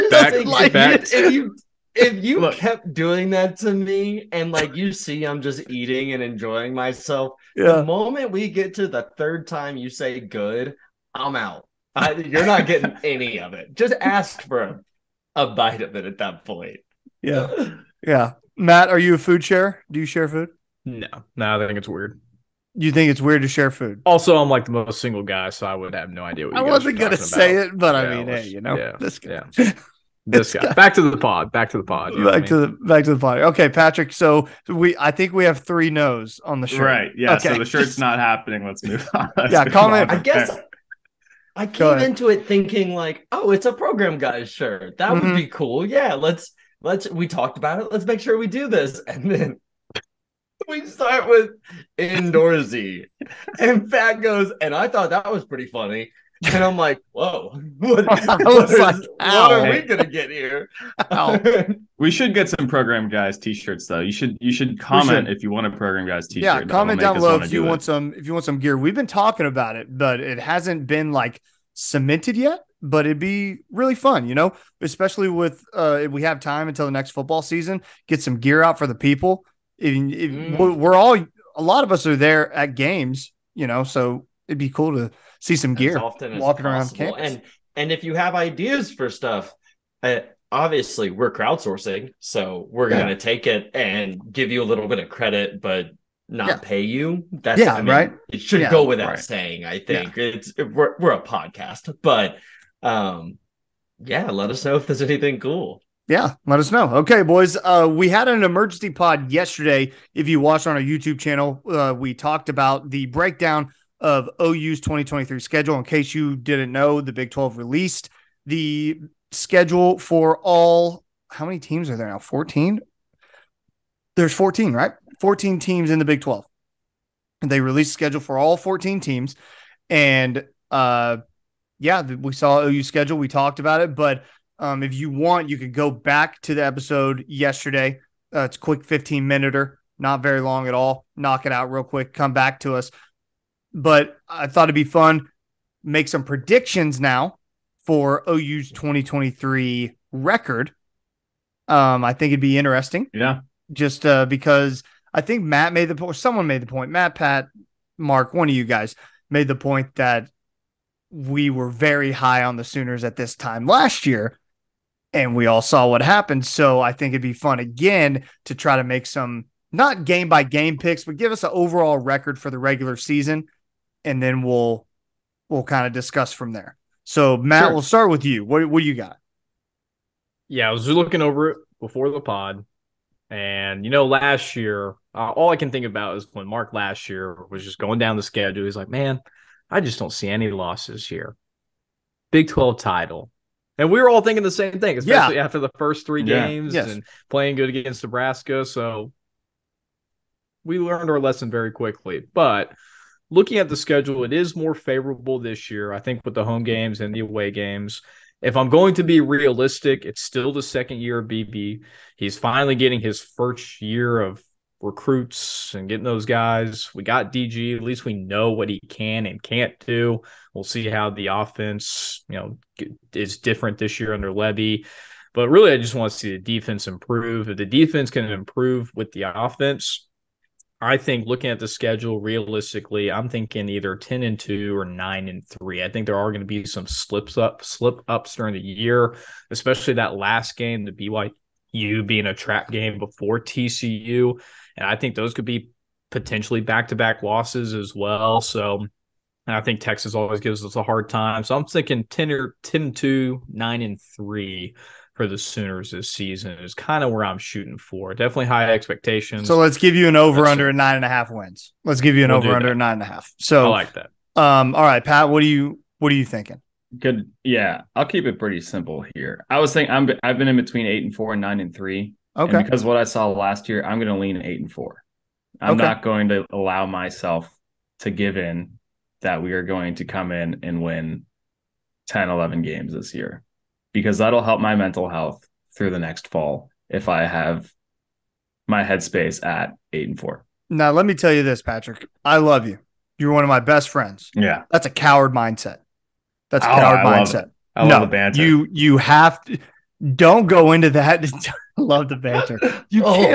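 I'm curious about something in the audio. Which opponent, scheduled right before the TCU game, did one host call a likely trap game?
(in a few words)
BYU.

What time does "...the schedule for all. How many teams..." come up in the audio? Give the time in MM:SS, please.
01:58.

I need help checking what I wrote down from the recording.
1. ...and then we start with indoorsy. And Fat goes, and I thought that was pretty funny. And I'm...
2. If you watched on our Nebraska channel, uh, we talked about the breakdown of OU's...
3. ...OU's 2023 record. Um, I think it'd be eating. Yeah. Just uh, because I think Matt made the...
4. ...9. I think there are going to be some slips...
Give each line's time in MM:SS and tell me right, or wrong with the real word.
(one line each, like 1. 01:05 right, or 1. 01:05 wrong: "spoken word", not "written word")
1. 00:49 right
2. 01:50 wrong: "YouTube", not "Nebraska"
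3. 02:28 wrong: "interesting", not "eating"
4. 03:55 wrong: "3", not "9".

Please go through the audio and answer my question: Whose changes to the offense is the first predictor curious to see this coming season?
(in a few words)
Lebby.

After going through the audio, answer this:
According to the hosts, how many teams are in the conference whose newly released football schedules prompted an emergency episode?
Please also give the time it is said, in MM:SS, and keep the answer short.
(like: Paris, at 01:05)
14, at 02:05.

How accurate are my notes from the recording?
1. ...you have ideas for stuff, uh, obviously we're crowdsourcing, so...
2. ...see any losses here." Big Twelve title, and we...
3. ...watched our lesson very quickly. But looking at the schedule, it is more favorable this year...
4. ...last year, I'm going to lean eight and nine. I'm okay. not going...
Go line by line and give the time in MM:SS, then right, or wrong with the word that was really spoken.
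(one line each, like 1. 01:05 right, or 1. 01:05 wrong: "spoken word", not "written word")
1. 01:28 right
2. 03:10 right
3. 03:20 wrong: "learned", not "watched"
4. 04:33 wrong: "four", not "nine".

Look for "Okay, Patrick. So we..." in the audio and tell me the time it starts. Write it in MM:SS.
00:33.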